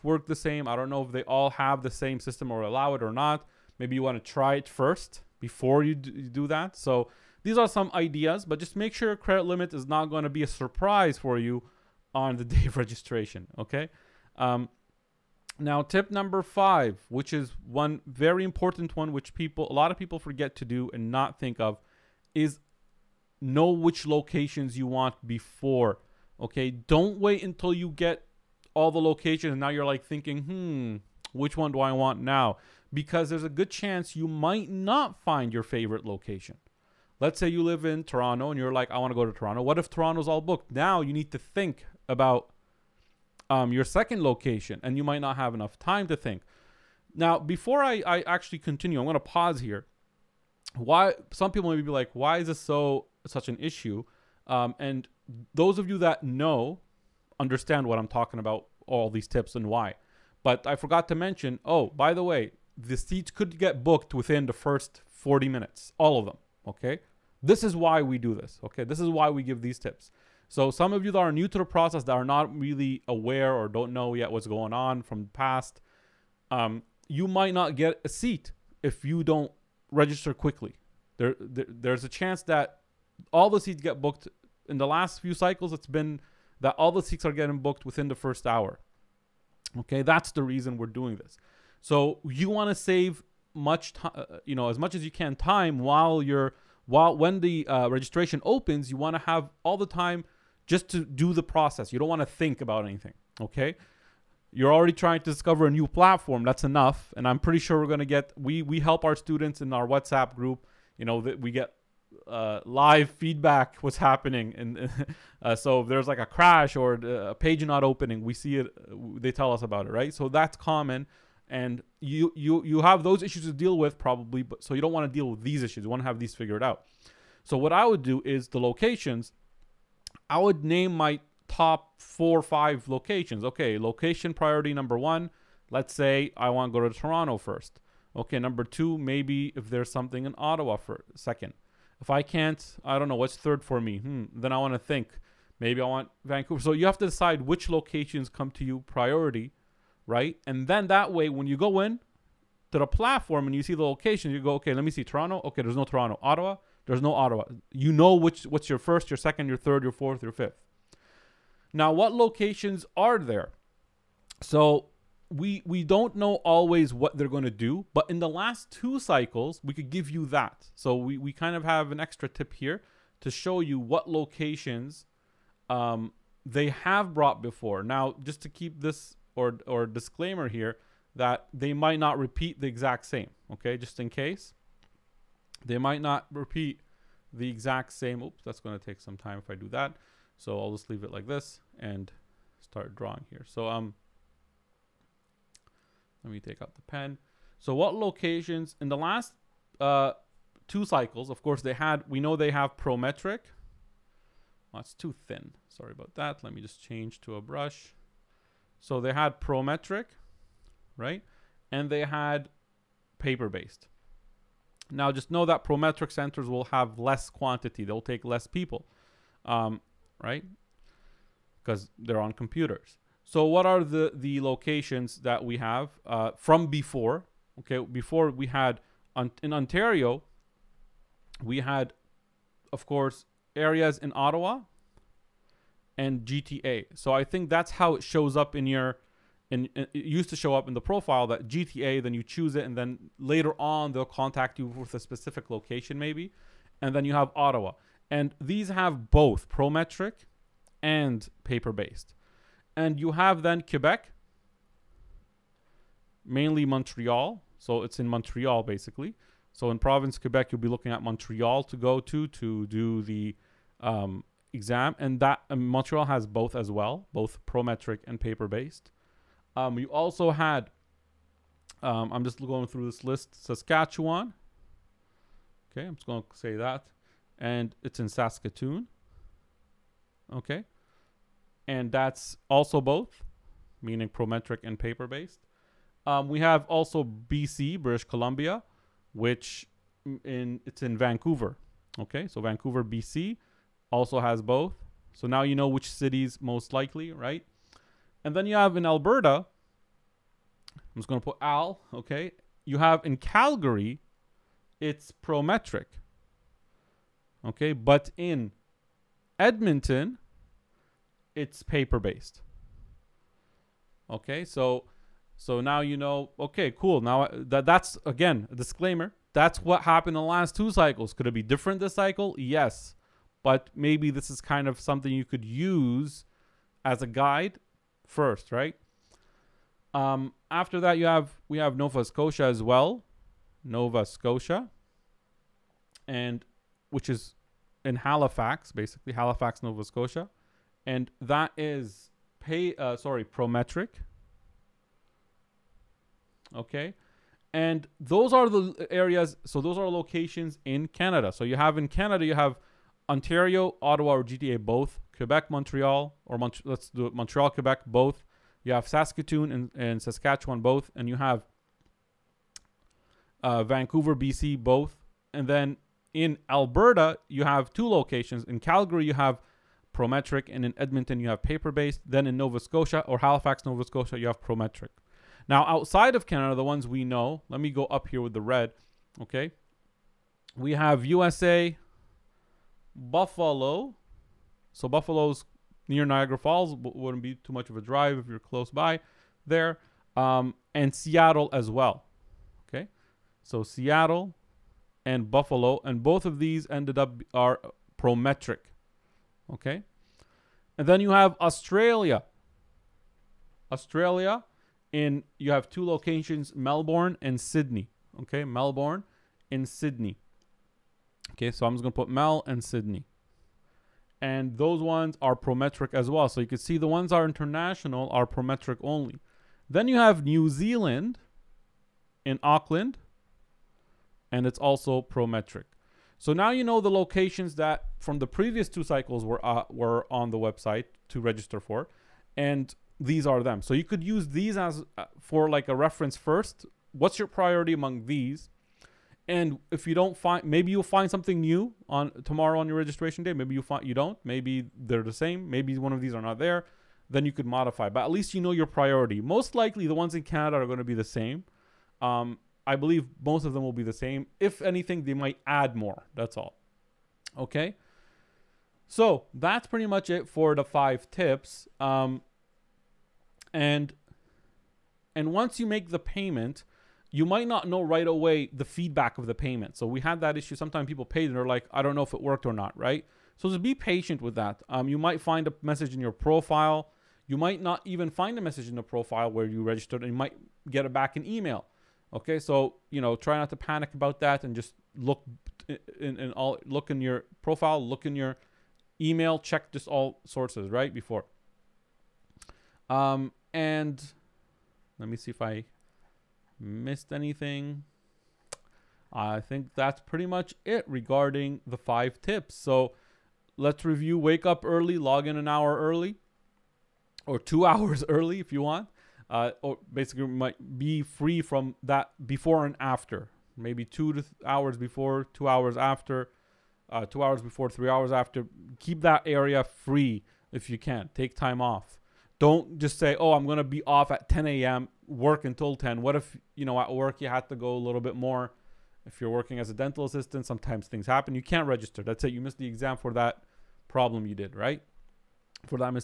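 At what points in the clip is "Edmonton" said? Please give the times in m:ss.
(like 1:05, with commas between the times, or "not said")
5:09, 6:10.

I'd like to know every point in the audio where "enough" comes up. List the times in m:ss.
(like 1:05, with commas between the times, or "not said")
0:45, 1:46.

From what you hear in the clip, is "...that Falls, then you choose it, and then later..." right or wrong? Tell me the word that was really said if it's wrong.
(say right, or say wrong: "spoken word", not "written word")
wrong: "GTA", not "Falls".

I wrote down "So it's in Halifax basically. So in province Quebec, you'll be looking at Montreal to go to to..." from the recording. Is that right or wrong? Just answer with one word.
wrong.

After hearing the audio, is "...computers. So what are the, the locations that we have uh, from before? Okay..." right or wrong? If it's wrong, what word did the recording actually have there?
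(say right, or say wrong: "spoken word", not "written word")
right.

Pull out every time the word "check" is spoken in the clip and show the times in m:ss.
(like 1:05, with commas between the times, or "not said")
8:09.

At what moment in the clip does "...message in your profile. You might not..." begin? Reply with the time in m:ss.
7:55.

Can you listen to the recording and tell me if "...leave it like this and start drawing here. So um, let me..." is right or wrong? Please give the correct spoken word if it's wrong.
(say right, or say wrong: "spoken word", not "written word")
right.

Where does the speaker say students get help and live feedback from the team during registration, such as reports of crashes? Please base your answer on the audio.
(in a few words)
WhatsApp group.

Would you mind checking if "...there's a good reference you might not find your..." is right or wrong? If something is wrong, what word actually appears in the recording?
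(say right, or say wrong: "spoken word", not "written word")
wrong: "chance", not "reference".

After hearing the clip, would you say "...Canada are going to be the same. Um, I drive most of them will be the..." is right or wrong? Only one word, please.
wrong.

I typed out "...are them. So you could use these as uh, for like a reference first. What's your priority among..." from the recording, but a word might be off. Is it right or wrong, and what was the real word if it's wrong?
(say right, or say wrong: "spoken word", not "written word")
right.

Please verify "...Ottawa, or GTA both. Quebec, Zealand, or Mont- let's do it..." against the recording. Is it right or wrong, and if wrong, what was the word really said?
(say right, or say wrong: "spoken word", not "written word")
wrong: "Montreal", not "Zealand".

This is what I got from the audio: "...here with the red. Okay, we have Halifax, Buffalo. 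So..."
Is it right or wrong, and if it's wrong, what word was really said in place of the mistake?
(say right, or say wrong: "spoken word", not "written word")
wrong: "USA", not "Halifax".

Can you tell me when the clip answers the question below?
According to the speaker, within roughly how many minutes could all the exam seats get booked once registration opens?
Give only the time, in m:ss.
1:05.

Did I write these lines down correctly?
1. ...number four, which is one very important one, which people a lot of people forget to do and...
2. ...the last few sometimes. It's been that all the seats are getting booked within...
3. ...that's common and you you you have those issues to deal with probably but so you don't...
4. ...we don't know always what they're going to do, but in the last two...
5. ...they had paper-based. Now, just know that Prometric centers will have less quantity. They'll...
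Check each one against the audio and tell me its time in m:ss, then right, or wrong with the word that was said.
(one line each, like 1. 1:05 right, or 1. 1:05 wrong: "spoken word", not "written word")
1. 0:16 wrong: "five", not "four"
2. 1:24 wrong: "cycles", not "sometimes"
3. 2:00 right
4. 2:45 right
5. 3:31 right.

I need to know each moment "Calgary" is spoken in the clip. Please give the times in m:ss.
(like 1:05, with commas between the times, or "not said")
5:03, 6:08.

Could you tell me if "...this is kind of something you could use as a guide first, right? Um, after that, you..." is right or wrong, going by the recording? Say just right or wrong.
right.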